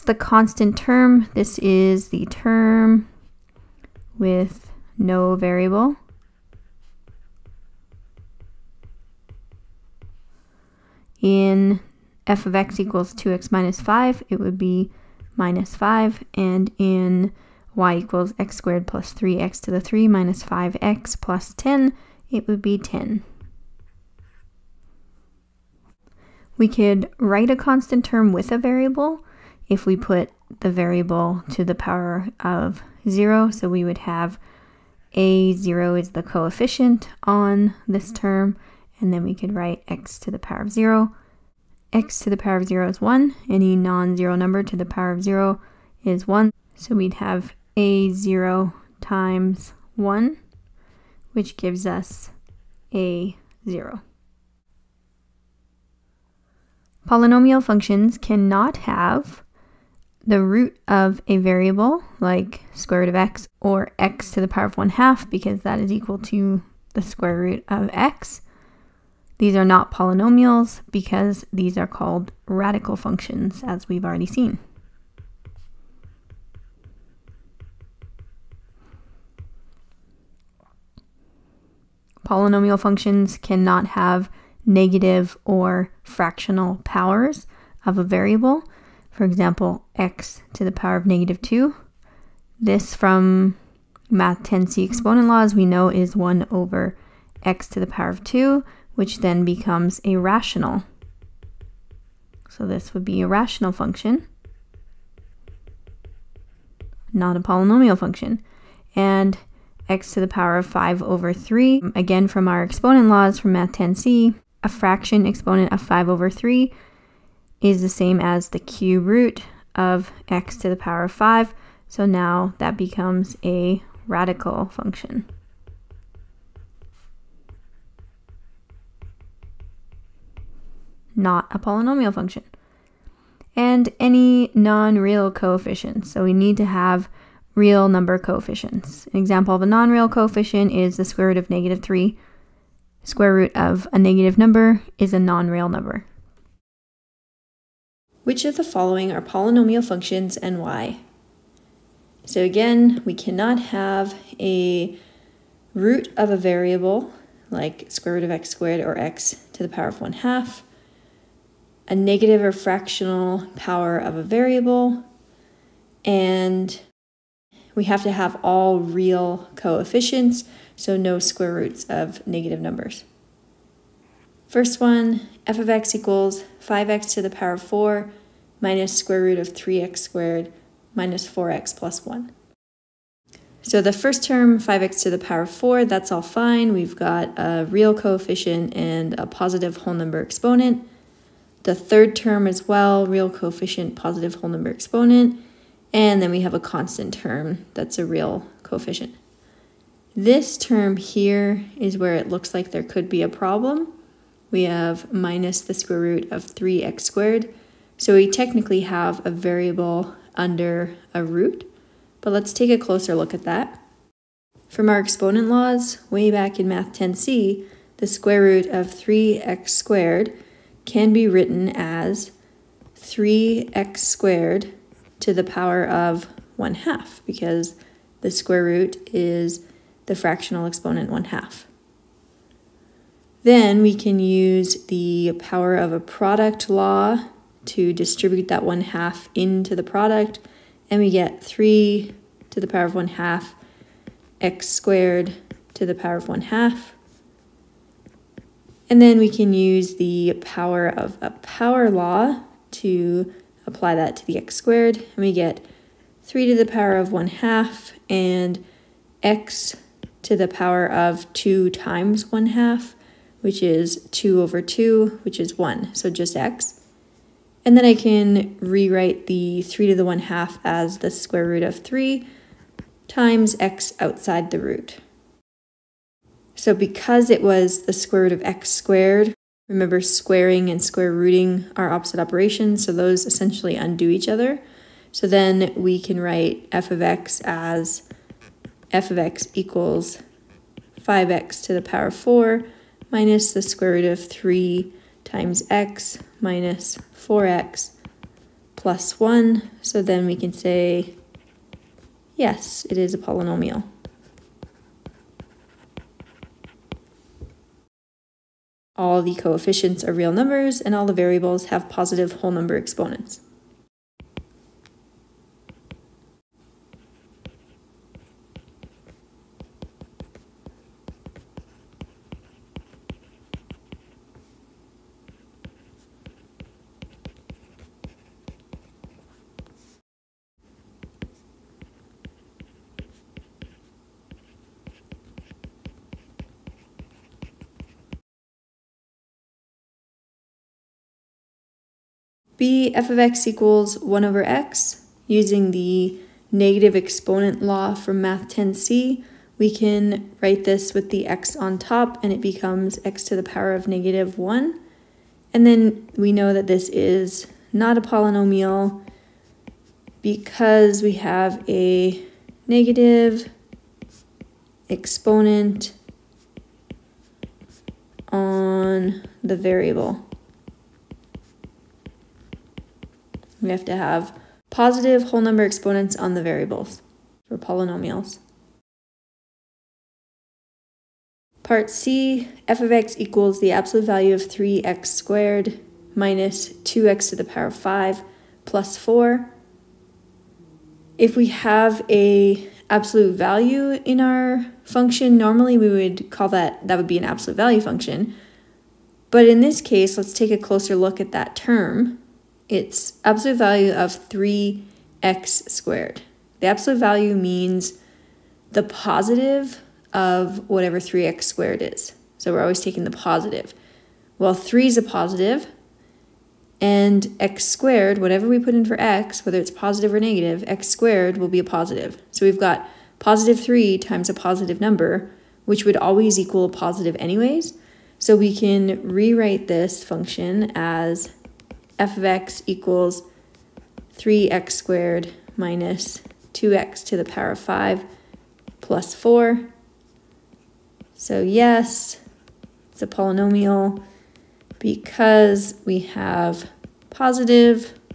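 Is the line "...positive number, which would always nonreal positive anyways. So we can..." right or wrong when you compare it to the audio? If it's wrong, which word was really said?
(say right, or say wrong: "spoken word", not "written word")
wrong: "equal", not "nonreal".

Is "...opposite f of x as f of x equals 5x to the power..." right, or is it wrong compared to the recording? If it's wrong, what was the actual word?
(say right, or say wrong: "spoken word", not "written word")
wrong: "write", not "opposite".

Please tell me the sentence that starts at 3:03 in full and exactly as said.
So the first term, 5x to the power of 4, that's all fine.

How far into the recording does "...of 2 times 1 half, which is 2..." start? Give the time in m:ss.
4:20.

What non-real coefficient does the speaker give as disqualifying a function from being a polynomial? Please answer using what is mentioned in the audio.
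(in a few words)
square root of negative 3.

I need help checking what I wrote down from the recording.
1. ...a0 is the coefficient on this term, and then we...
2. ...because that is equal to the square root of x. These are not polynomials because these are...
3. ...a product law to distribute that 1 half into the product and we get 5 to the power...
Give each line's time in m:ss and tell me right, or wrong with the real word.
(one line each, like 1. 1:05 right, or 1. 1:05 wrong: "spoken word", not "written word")
1. 0:35 right
2. 1:05 right
3. 3:55 wrong: "3", not "5".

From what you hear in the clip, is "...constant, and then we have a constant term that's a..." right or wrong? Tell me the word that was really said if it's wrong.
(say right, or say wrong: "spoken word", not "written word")
wrong: "exponent", not "constant".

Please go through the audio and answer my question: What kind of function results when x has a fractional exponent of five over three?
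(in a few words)
radical function.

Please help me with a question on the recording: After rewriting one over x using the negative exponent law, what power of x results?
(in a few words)
negative 1.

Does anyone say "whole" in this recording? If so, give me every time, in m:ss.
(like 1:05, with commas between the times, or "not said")
3:09, 3:14, 5:12, 6:15.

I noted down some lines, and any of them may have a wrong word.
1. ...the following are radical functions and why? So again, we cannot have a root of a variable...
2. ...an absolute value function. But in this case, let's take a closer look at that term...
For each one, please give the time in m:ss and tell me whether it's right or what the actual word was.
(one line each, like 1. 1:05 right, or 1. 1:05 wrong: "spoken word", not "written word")
1. 2:28 wrong: "polynomial", not "radical"
2. 6:37 right.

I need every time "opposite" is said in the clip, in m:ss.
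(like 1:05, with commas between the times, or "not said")
4:41.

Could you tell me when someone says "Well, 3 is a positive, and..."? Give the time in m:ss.
6:54.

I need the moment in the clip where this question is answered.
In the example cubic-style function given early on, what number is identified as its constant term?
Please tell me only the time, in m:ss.
0:22.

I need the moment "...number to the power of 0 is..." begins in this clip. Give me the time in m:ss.
0:44.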